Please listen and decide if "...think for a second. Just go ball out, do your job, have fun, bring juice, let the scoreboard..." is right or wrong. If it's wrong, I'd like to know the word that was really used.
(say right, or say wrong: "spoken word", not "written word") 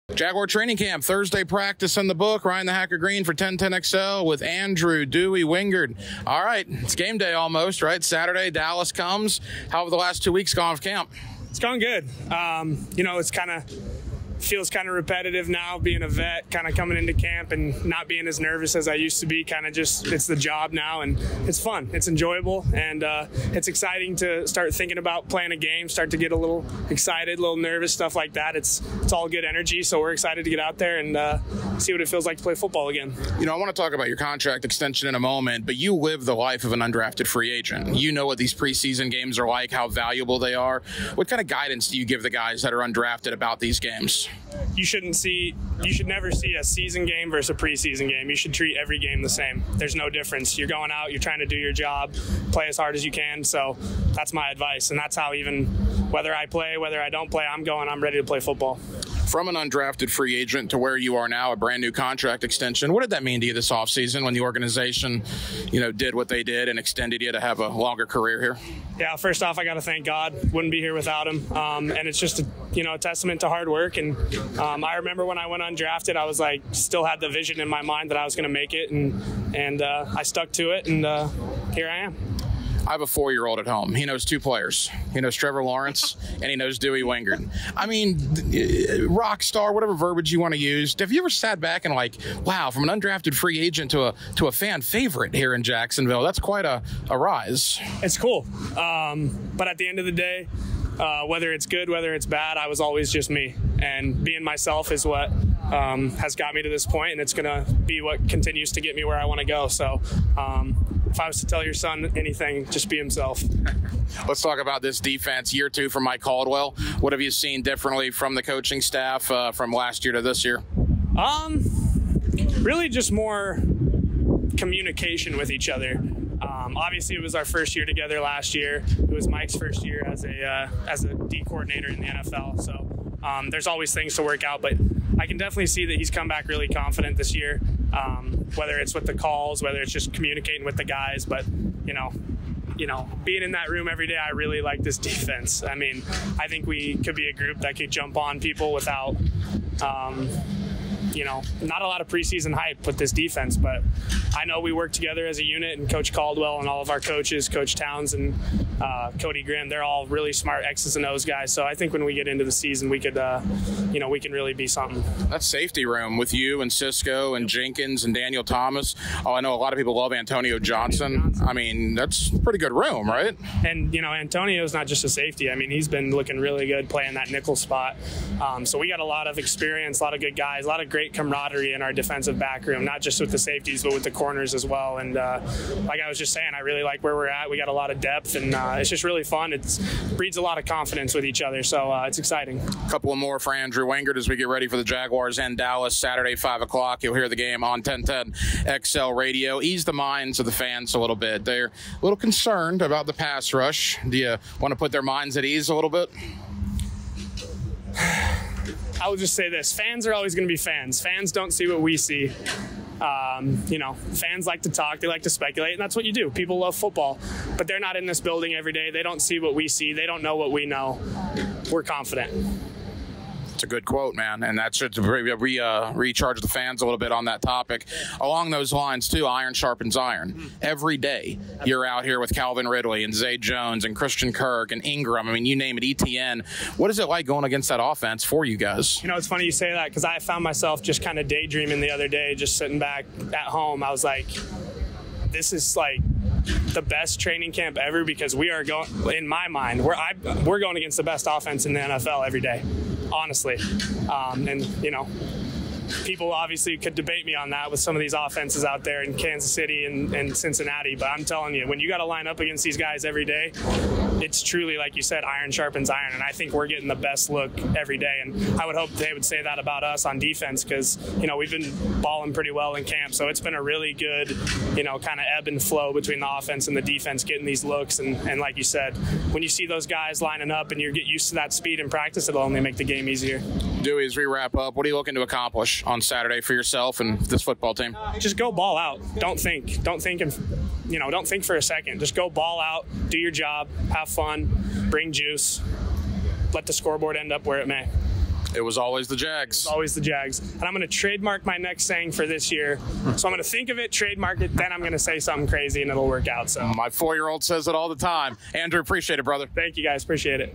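right.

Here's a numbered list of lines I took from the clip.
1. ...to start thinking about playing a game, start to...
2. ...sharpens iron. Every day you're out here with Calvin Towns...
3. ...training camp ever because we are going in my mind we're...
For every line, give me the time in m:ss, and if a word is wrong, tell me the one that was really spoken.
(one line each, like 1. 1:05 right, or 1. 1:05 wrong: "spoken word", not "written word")
1. 0:24 right
2. 3:49 wrong: "Ridley", not "Towns"
3. 4:07 right.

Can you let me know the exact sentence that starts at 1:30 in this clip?
Have you ever sat back and like, wow, from an undrafted free agent to a to a fan favorite here in Jacksonville?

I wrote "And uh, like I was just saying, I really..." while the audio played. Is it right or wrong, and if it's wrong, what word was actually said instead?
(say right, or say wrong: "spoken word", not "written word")
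right.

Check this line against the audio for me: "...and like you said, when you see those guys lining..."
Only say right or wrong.
right.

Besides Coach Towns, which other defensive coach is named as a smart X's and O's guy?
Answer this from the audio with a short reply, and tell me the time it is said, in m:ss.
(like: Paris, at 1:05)
Cody Grimm, at 2:39.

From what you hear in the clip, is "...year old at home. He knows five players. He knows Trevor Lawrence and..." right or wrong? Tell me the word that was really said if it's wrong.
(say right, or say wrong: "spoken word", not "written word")
wrong: "two", not "five".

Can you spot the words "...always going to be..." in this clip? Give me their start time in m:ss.
3:30.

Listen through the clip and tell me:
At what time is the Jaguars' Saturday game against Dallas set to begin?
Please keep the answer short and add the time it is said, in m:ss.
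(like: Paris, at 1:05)
5 o'clock, at 3:16.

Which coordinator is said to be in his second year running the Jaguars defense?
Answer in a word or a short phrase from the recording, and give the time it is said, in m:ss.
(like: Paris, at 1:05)
Mike Caldwell, at 1:56.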